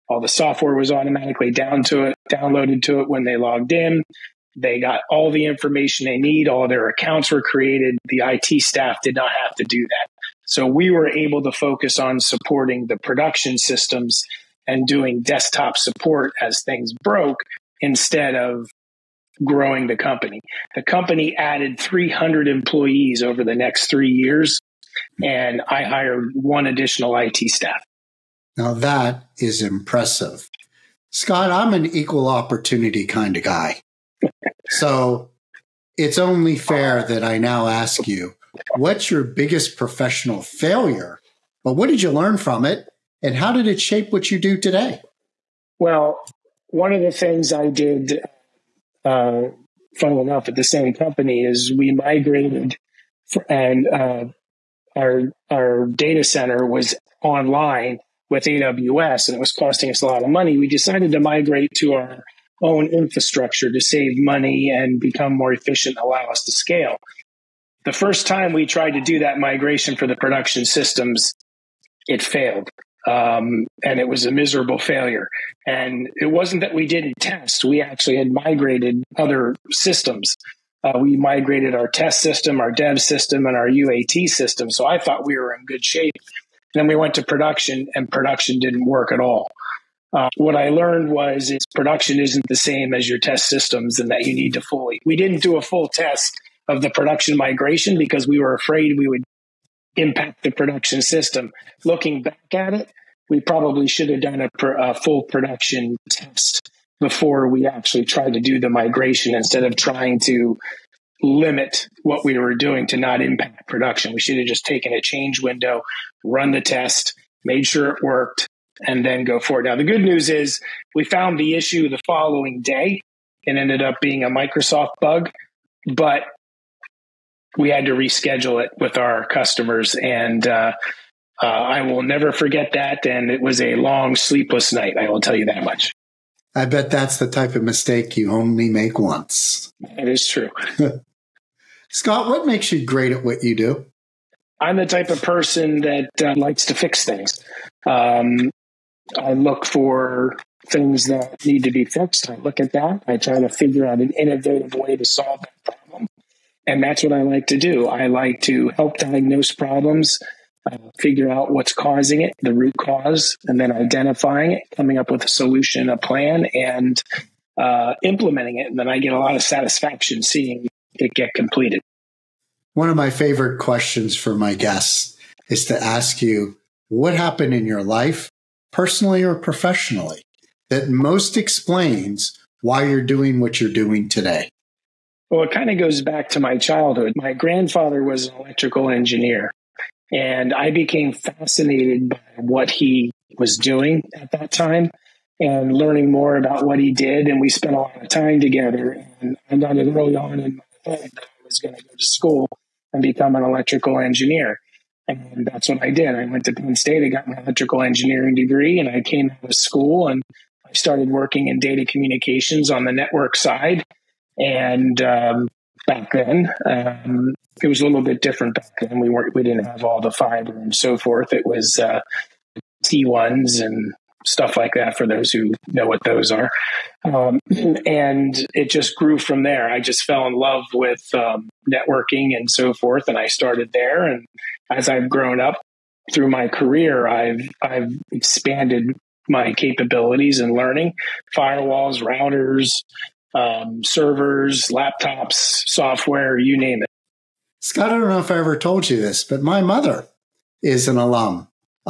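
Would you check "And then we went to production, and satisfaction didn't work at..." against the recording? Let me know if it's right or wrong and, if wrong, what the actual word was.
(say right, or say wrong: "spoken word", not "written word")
wrong: "production", not "satisfaction".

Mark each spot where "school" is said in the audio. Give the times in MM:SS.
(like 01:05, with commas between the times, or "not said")
03:22, 03:29.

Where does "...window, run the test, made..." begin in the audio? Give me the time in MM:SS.
01:55.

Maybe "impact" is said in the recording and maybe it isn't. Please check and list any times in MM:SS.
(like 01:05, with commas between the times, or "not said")
01:39, 01:53.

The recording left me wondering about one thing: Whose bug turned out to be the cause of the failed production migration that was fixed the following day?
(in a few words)
Microsoft.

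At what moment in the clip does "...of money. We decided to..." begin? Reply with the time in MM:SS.
01:00.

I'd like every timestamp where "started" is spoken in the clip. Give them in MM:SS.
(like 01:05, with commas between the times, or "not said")
03:30, 03:53.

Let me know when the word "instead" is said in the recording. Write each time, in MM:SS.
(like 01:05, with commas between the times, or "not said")
00:17, 01:49.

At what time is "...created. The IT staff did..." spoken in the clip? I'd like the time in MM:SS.
00:07.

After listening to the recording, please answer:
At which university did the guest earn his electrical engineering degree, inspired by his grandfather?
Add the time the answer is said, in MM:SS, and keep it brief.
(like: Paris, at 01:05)
Penn State, at 03:26.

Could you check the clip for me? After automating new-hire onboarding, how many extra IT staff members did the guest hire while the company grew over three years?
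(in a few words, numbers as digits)
1.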